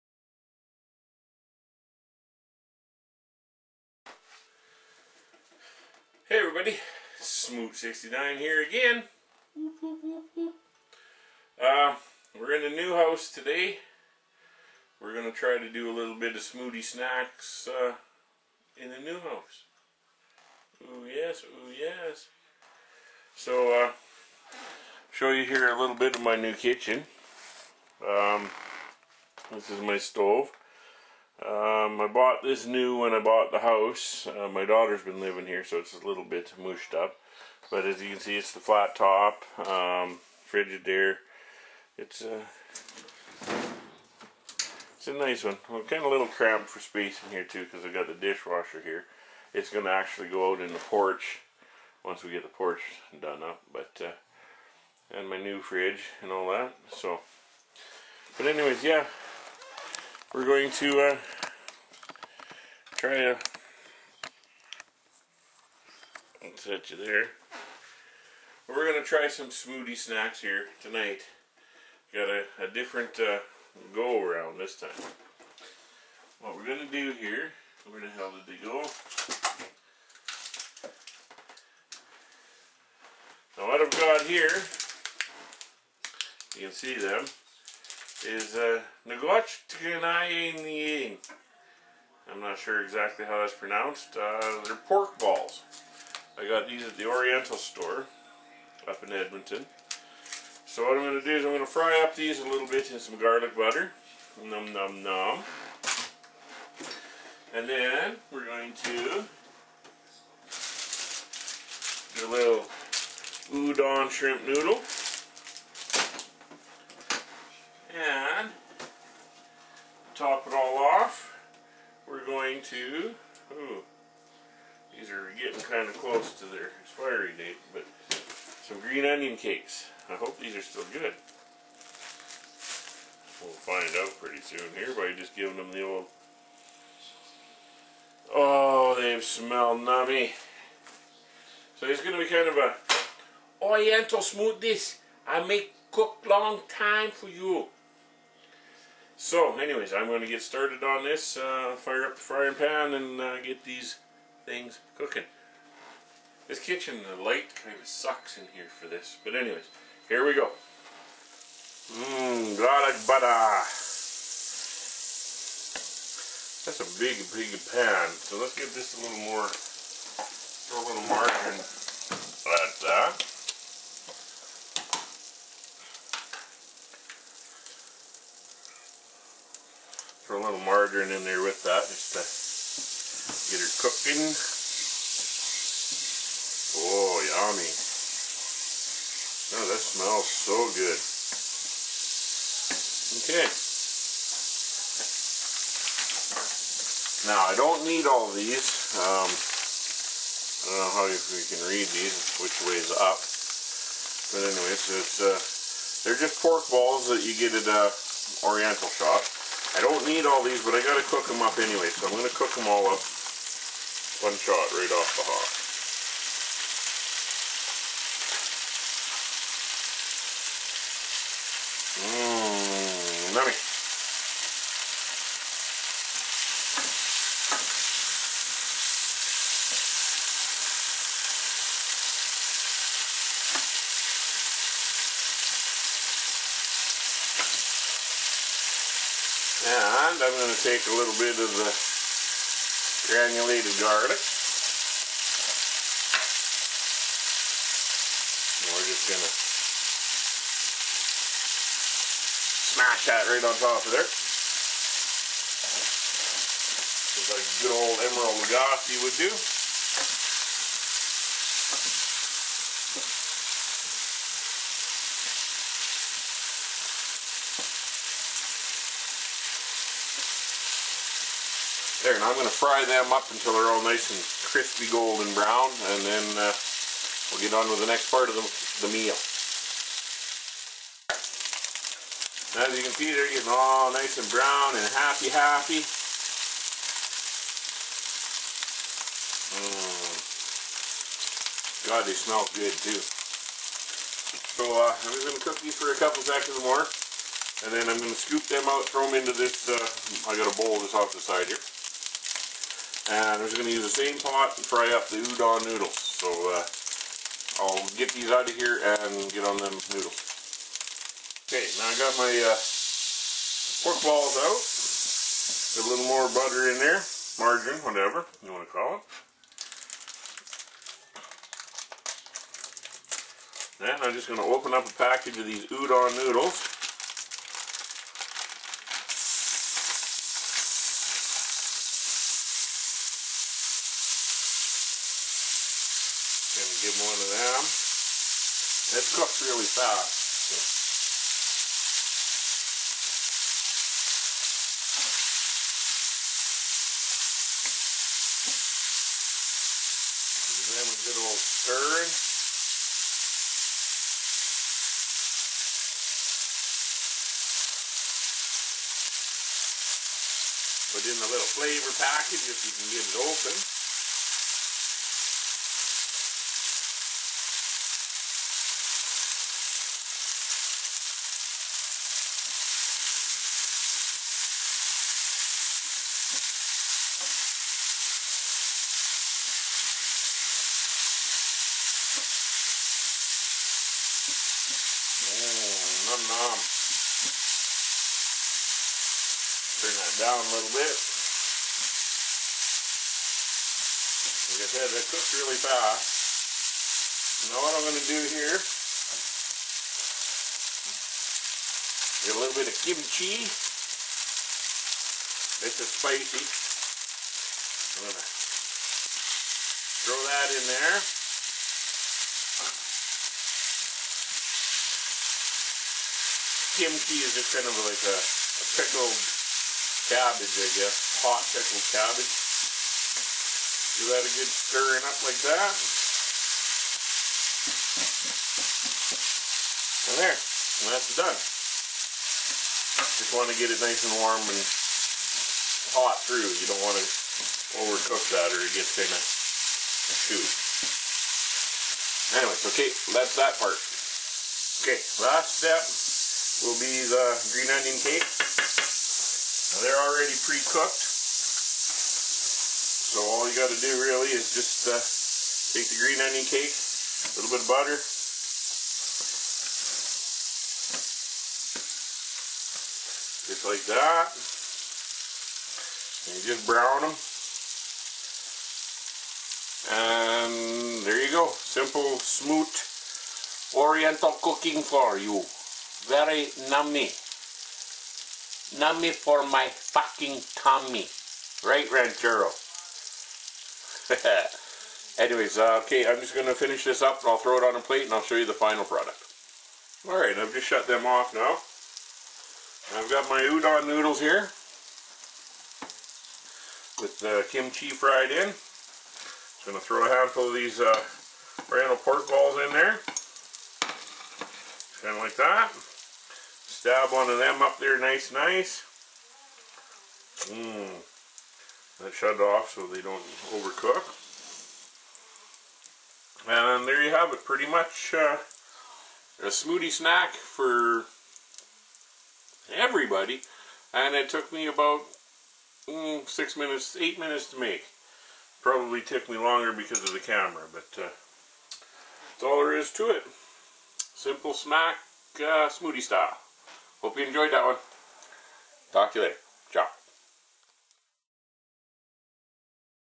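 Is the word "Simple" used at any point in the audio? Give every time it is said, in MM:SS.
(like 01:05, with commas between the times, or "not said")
07:51, 08:54.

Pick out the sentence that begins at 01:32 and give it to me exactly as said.
I'm not sure exactly how that's pronounced.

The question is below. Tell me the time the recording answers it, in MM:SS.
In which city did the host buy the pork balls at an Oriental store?
01:39.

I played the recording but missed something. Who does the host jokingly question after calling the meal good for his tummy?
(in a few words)
Ranchero.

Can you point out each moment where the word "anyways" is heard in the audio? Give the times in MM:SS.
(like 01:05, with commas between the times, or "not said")
00:58, 02:29, 02:39, 03:24, 03:31, 07:22, 08:05.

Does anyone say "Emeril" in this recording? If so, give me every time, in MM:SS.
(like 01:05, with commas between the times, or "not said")
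04:18.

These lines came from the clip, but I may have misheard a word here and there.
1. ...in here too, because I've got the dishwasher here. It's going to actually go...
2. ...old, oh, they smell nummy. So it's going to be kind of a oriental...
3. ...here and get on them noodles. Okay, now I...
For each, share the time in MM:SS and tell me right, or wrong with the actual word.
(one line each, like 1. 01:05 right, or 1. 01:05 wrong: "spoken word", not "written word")
1. 00:47 right
2. 02:15 right
3. 05:08 right.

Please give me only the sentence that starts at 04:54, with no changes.
So uh, I'm just going to cook these for a couple seconds more.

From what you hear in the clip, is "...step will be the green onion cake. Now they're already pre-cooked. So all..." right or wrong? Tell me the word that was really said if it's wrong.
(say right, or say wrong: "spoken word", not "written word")
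right.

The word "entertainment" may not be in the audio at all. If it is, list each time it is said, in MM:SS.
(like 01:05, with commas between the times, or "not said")
not said.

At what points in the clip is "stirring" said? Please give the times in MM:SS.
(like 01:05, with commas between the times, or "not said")
05:51, 07:04.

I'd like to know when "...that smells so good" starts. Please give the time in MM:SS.
03:09.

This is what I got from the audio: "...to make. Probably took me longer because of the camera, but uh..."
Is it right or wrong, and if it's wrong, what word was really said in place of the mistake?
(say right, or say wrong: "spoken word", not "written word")
right.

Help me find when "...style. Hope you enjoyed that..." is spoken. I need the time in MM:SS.
08:56.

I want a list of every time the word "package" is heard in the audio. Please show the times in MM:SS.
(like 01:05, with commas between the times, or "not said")
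05:24, 06:01.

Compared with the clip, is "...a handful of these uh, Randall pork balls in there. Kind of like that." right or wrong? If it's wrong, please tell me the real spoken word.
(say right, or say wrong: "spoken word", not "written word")
right.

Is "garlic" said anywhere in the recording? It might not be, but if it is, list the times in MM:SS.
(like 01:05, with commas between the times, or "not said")
01:43, 02:42, 04:03.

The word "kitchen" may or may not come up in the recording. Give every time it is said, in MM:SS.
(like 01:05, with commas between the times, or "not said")
00:26, 02:36.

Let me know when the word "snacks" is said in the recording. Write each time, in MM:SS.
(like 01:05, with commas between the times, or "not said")
00:16, 01:09, 08:39, 08:54.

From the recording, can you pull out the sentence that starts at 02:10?
I hope these are still good.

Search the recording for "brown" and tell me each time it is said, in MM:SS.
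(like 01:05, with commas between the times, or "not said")
04:35, 04:44, 07:46.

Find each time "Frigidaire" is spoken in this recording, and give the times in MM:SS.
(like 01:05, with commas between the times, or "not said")
00:40.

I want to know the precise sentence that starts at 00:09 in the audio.
Whoop, whoop, whoop, uh, we're in a new house today.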